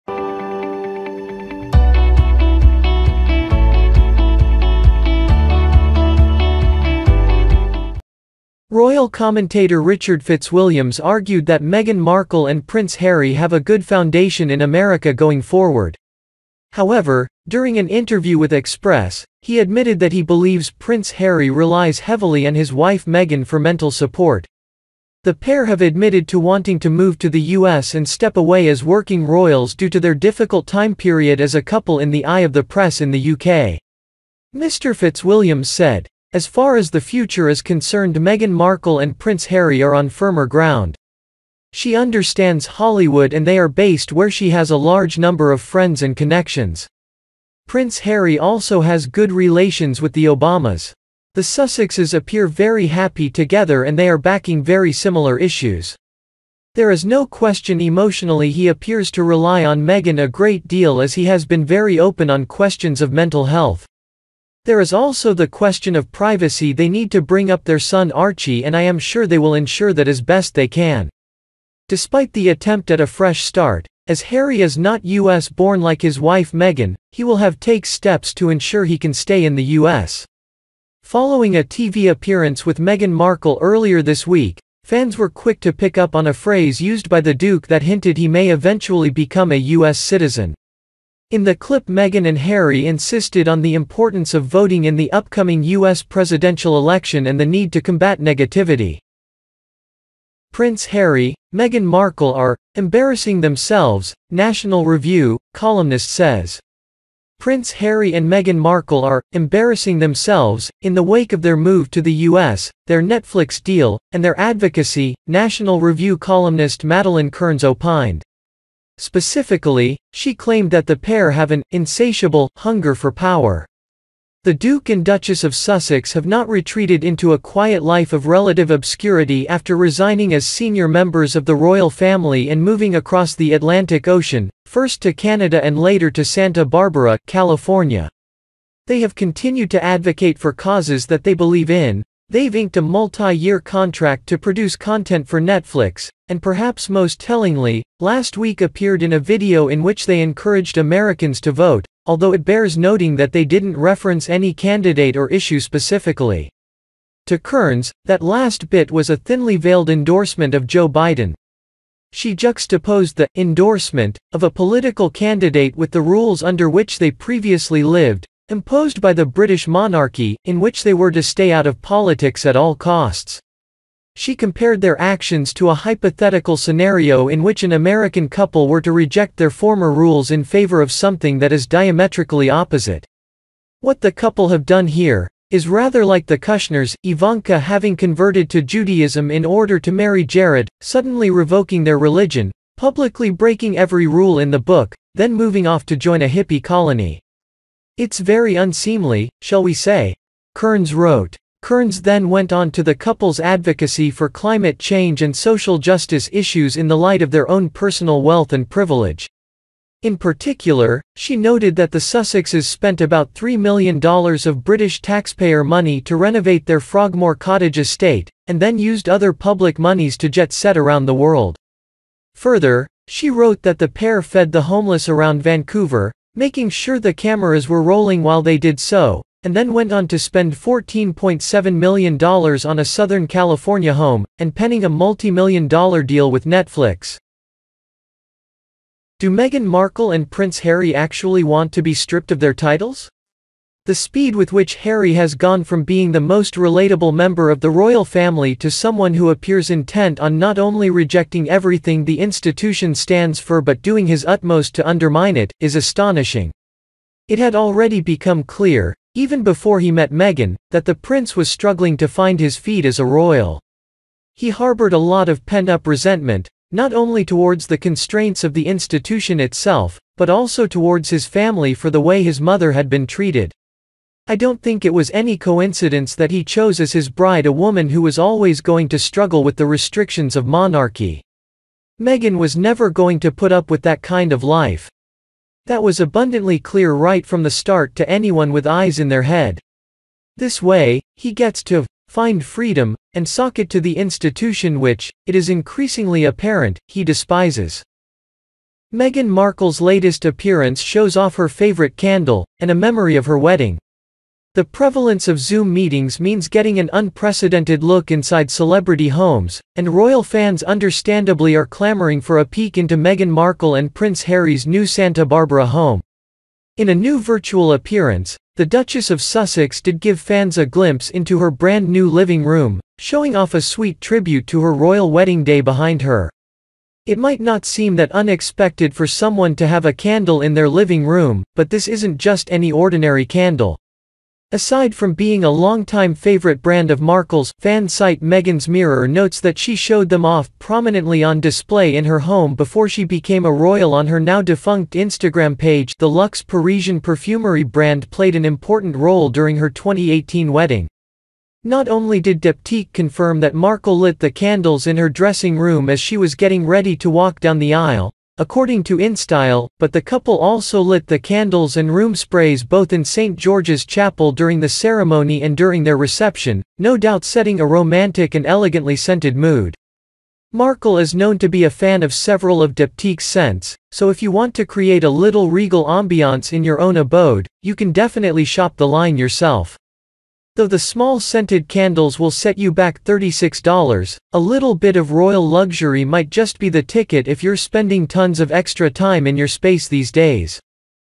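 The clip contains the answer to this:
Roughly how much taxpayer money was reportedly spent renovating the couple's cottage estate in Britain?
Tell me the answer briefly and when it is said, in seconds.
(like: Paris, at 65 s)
$3 million, at 213 s.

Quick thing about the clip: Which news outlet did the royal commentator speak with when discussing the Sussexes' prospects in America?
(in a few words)
Express.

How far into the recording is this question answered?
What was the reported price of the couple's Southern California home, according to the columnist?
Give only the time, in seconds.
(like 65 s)
230 s.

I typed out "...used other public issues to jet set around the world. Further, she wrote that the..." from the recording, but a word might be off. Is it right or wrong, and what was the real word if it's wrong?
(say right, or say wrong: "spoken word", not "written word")
wrong: "monies", not "issues".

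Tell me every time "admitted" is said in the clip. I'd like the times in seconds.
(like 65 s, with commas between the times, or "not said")
19 s, 25 s.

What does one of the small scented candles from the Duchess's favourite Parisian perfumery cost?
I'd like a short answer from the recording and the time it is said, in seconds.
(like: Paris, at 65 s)
$36, at 383 s.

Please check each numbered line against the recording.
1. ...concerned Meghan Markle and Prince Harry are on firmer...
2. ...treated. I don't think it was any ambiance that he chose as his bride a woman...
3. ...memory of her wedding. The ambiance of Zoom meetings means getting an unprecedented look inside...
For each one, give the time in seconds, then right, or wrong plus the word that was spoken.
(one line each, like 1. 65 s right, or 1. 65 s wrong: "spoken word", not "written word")
1. 37 s right
2. 273 s wrong: "coincidence", not "ambiance"
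3. 302 s wrong: "prevalence", not "ambiance".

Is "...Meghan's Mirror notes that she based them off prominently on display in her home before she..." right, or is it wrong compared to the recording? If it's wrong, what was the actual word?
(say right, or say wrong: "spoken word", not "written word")
wrong: "showed", not "based".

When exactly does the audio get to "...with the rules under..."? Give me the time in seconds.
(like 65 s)
165 s.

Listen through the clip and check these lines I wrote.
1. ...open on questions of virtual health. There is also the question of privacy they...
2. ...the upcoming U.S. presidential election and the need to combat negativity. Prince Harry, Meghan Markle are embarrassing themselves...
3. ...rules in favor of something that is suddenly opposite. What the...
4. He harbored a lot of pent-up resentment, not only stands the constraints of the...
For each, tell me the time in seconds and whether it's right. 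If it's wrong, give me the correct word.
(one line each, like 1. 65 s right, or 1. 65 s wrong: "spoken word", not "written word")
1. 61 s wrong: "mental", not "virtual"
2. 94 s right
3. 179 s wrong: "diametrically", not "suddenly"
4. 264 s wrong: "towards", not "stands".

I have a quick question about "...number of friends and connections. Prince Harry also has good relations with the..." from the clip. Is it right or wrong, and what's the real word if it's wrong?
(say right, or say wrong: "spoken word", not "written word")
right.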